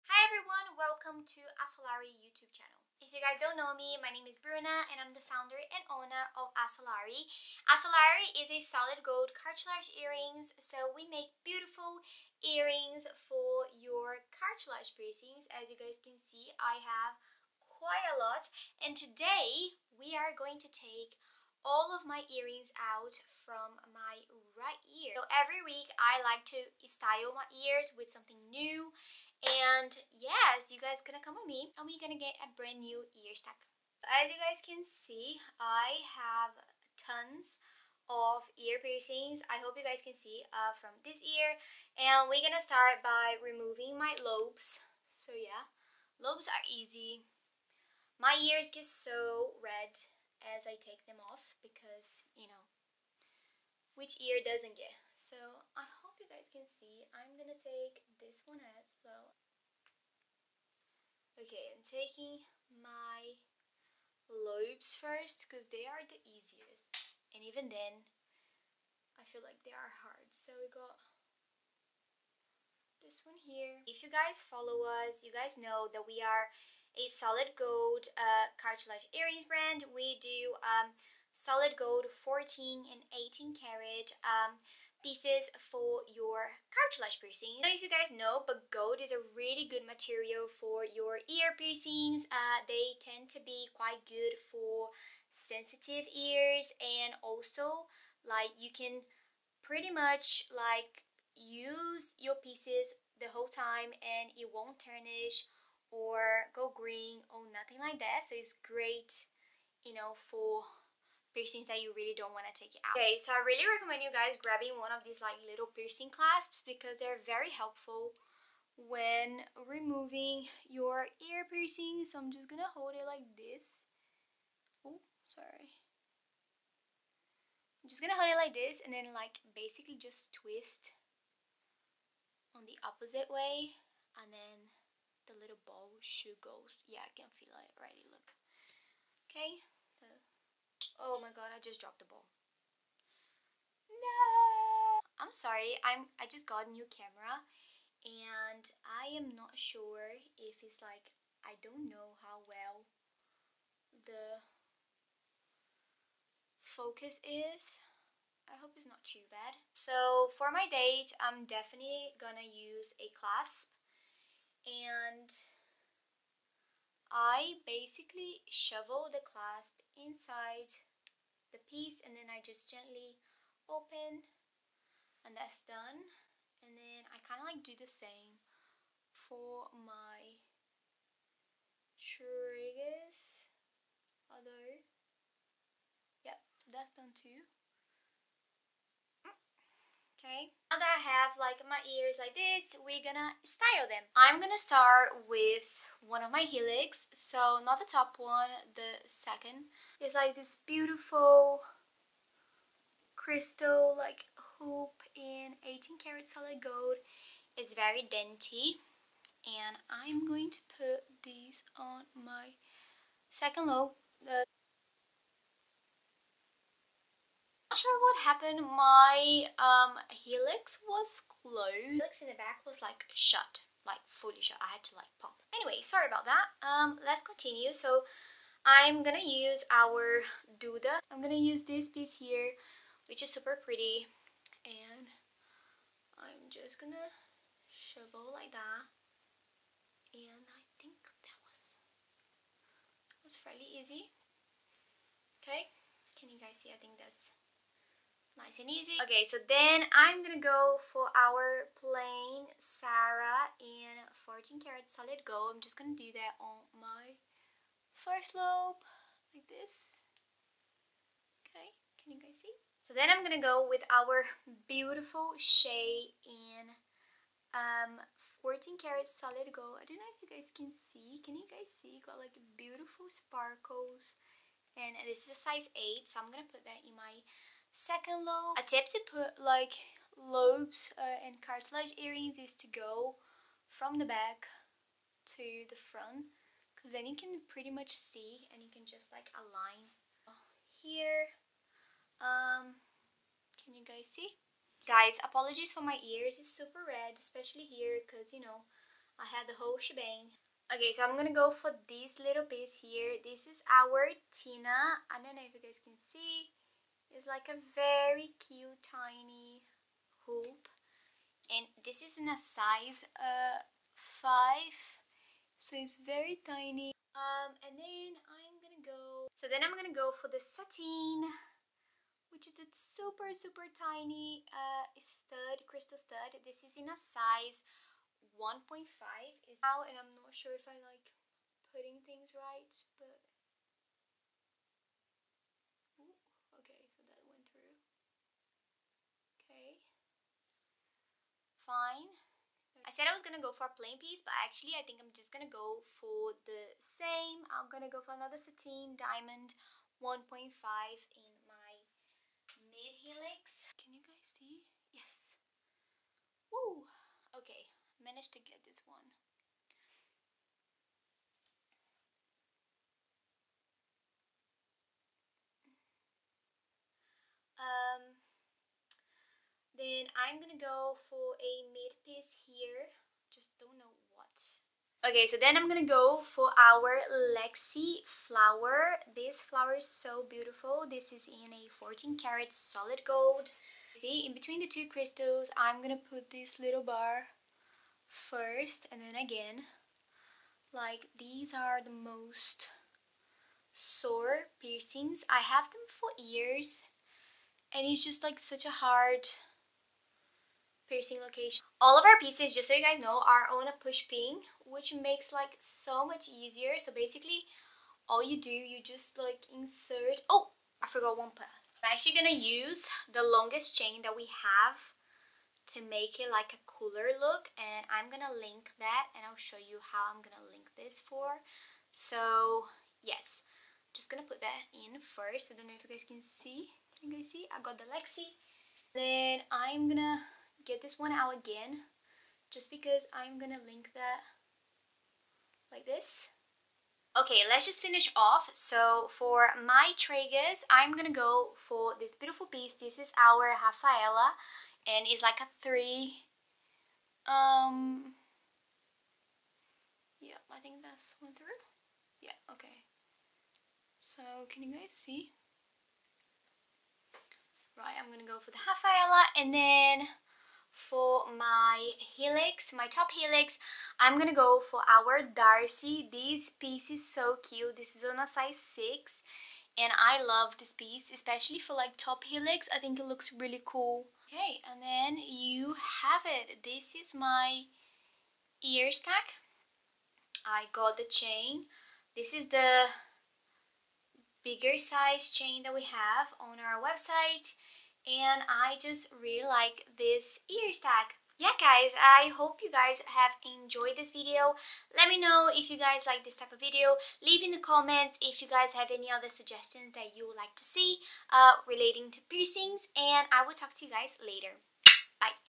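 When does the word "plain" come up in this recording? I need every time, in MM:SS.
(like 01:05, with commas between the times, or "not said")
04:11, 05:43.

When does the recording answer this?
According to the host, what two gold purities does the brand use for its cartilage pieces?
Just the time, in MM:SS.
01:22.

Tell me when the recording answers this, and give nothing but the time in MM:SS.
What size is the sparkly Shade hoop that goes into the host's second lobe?
04:35.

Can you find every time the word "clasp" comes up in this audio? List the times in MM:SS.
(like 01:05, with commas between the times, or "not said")
01:56, 02:43, 02:49.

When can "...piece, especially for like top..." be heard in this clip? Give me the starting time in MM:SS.
07:50.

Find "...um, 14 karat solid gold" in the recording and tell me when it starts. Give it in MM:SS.
04:27.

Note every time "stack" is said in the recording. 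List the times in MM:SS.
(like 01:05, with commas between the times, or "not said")
00:33, 07:58, 08:10.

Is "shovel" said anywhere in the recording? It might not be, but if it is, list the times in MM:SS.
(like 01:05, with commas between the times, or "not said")
02:48, 03:57.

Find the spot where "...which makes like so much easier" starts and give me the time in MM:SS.
06:44.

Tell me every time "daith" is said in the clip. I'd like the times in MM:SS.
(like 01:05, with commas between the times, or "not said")
02:40.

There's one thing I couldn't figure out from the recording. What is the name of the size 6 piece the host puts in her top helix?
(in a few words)
Darcy.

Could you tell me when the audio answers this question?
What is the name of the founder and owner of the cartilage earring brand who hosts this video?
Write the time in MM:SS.
00:04.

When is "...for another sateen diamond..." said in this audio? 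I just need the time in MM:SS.
05:48.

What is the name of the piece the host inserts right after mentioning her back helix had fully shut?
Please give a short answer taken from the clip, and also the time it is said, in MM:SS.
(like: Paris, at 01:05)
Duda, at 03:50.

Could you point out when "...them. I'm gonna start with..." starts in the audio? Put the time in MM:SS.
03:13.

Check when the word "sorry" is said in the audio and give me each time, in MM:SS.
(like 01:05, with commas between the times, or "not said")
02:05, 02:25, 03:45.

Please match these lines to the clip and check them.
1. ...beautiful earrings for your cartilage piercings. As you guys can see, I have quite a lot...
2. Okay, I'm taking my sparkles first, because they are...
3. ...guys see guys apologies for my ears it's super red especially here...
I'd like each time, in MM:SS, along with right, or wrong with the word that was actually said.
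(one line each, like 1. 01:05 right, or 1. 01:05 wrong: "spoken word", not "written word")
1. 00:11 right
2. 01:01 wrong: "lobes", not "sparkles"
3. 04:53 right.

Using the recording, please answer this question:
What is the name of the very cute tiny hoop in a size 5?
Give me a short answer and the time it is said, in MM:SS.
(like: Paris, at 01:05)
Tina, at 05:04.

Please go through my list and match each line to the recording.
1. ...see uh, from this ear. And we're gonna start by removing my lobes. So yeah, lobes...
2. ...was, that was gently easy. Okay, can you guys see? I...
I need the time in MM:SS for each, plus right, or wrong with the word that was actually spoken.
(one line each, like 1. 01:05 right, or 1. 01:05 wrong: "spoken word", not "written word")
1. 00:40 right
2. 04:01 wrong: "fairly", not "gently".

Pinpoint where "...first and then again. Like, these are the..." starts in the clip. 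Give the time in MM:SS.
06:28.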